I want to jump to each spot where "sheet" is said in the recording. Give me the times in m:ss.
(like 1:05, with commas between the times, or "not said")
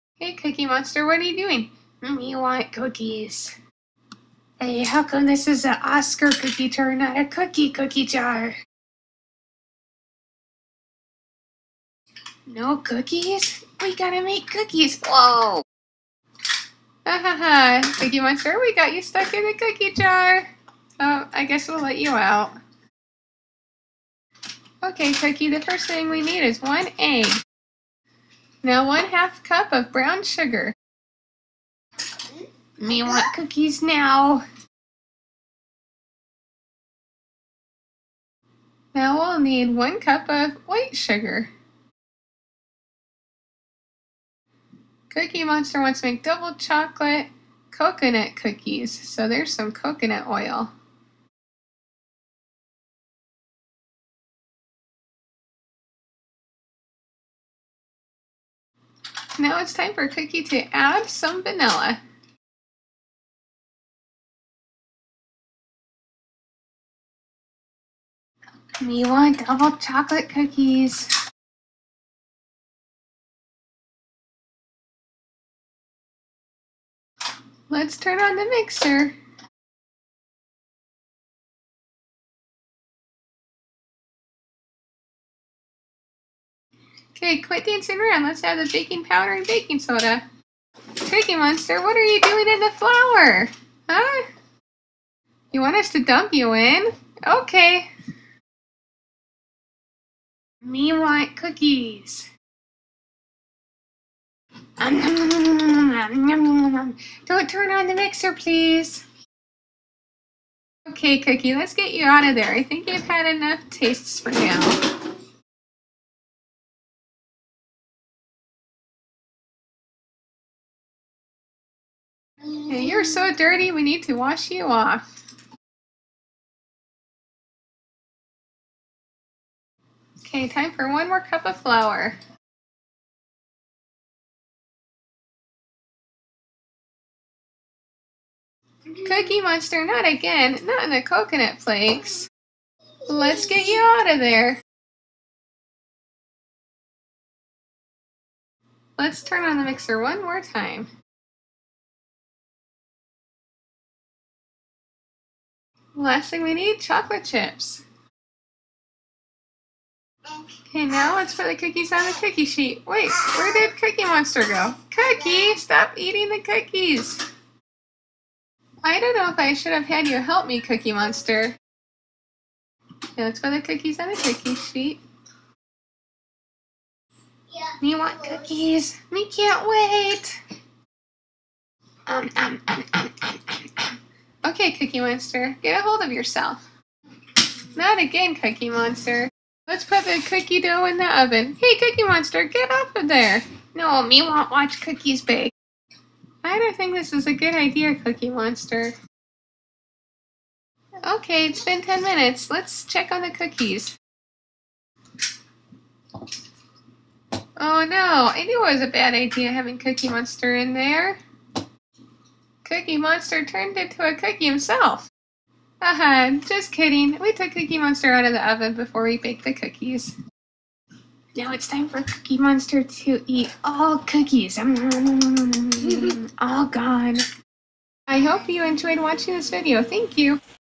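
2:42, 2:54.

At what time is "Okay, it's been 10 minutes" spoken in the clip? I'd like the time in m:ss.
3:21.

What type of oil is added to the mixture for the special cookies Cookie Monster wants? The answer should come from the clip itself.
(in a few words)
Coconut oil.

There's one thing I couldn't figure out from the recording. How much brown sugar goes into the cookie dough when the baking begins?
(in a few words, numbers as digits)
1/2 cup.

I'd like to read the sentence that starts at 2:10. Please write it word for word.
Okay, time for one more cup of flour.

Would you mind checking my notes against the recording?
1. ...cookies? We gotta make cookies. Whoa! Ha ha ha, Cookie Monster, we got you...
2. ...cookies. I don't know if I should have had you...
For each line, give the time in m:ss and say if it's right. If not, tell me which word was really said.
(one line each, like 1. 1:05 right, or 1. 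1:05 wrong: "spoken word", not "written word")
1. 0:12 right
2. 2:46 right.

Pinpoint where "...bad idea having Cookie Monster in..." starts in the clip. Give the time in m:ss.
3:28.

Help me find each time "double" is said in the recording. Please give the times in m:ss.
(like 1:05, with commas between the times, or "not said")
0:46, 1:09.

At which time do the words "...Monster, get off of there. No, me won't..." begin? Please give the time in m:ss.
3:12.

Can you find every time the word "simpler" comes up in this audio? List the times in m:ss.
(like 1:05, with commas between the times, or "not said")
not said.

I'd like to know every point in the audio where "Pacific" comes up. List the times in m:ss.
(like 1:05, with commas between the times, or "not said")
not said.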